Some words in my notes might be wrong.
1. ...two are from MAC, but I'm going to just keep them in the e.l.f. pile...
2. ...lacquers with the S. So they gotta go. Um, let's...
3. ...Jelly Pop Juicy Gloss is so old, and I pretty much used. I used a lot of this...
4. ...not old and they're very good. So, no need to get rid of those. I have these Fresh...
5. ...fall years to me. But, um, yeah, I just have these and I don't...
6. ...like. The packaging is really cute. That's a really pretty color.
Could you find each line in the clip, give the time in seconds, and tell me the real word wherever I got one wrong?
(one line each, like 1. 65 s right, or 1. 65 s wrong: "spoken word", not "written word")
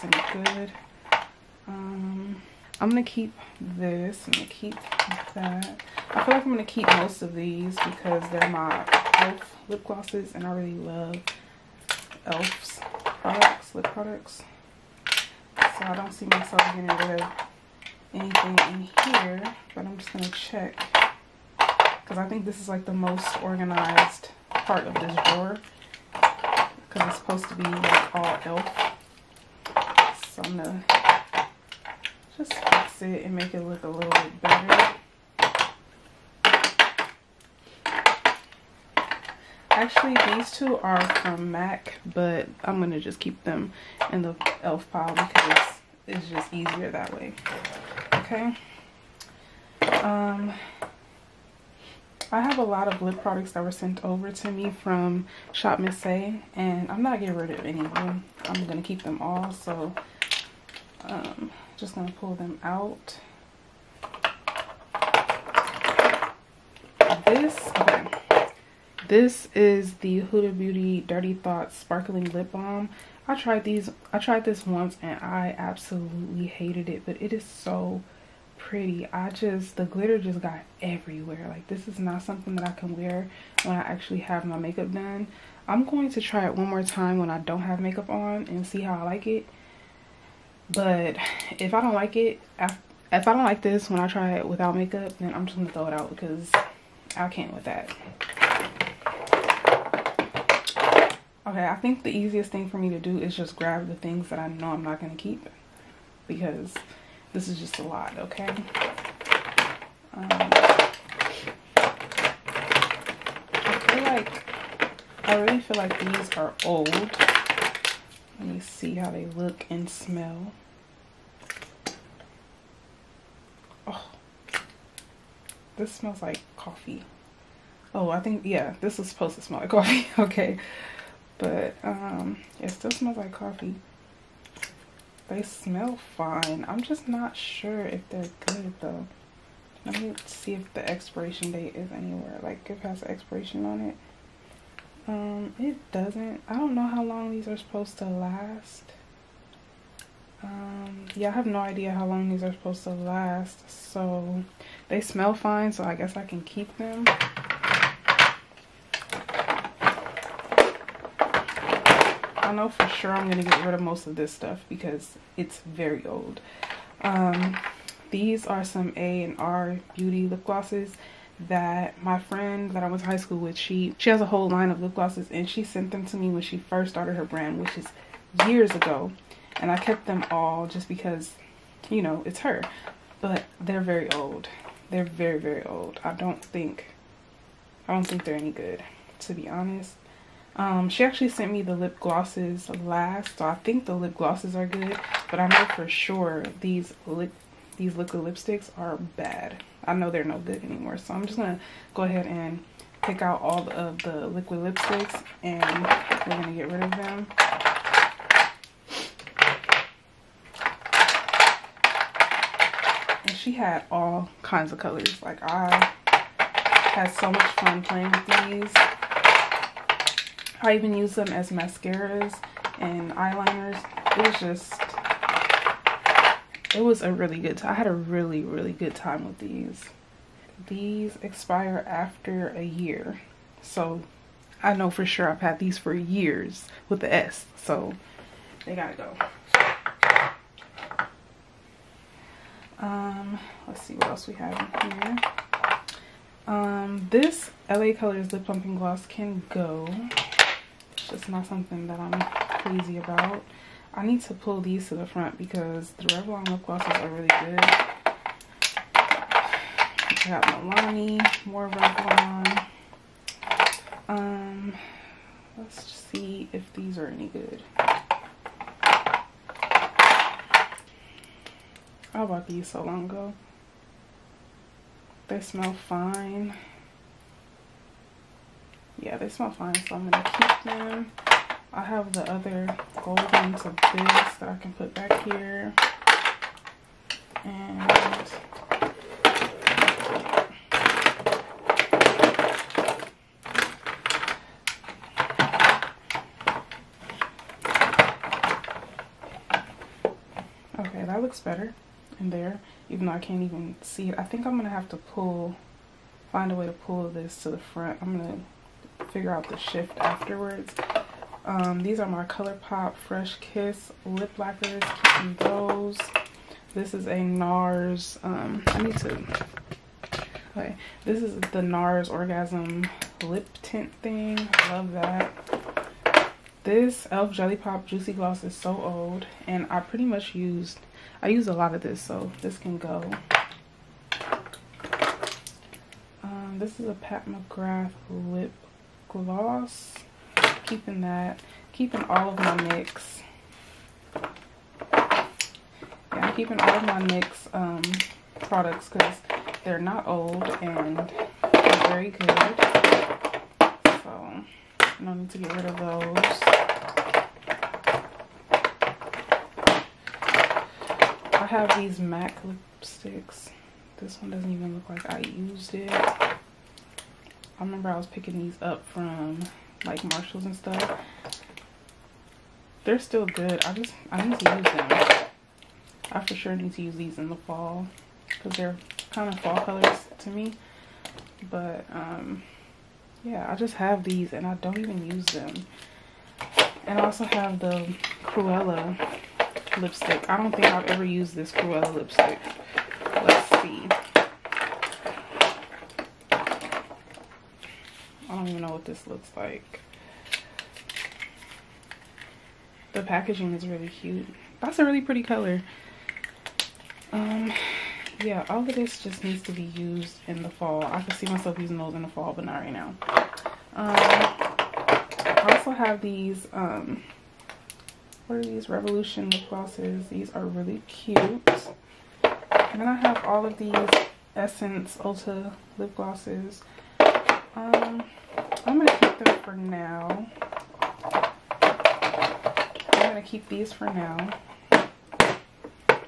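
1. 40 s right
2. 235 s wrong: "years", not "lacquers"
3. 327 s right
4. 349 s wrong: "MAC", not "Fresh"
5. 379 s wrong: "colors", not "years"
6. 399 s right.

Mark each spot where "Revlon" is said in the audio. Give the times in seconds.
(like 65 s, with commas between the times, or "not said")
256 s, 261 s.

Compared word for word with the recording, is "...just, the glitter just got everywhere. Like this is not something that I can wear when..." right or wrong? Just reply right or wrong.
right.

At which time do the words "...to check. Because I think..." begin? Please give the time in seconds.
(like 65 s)
20 s.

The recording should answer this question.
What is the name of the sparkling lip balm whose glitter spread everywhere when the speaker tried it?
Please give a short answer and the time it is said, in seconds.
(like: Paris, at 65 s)
Dirty Thoughts, at 70 s.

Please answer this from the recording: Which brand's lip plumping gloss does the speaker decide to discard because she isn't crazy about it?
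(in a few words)
LA Colors.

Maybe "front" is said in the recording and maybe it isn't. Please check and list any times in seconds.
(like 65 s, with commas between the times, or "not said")
255 s, 307 s.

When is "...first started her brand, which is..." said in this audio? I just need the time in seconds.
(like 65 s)
176 s.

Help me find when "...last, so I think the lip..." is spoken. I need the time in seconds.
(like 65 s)
192 s.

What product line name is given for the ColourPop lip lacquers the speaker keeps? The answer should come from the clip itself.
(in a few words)
Fresh Kiss.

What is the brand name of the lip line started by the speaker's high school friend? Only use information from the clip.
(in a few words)
A&R Beauty.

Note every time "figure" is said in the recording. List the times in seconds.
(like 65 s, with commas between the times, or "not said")
309 s.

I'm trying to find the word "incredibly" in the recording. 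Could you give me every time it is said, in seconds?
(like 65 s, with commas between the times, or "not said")
not said.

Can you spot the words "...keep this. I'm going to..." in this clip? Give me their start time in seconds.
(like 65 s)
3 s.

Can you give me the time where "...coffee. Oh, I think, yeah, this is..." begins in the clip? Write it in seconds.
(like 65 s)
126 s.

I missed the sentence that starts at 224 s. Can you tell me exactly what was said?
It was just it was a really good time.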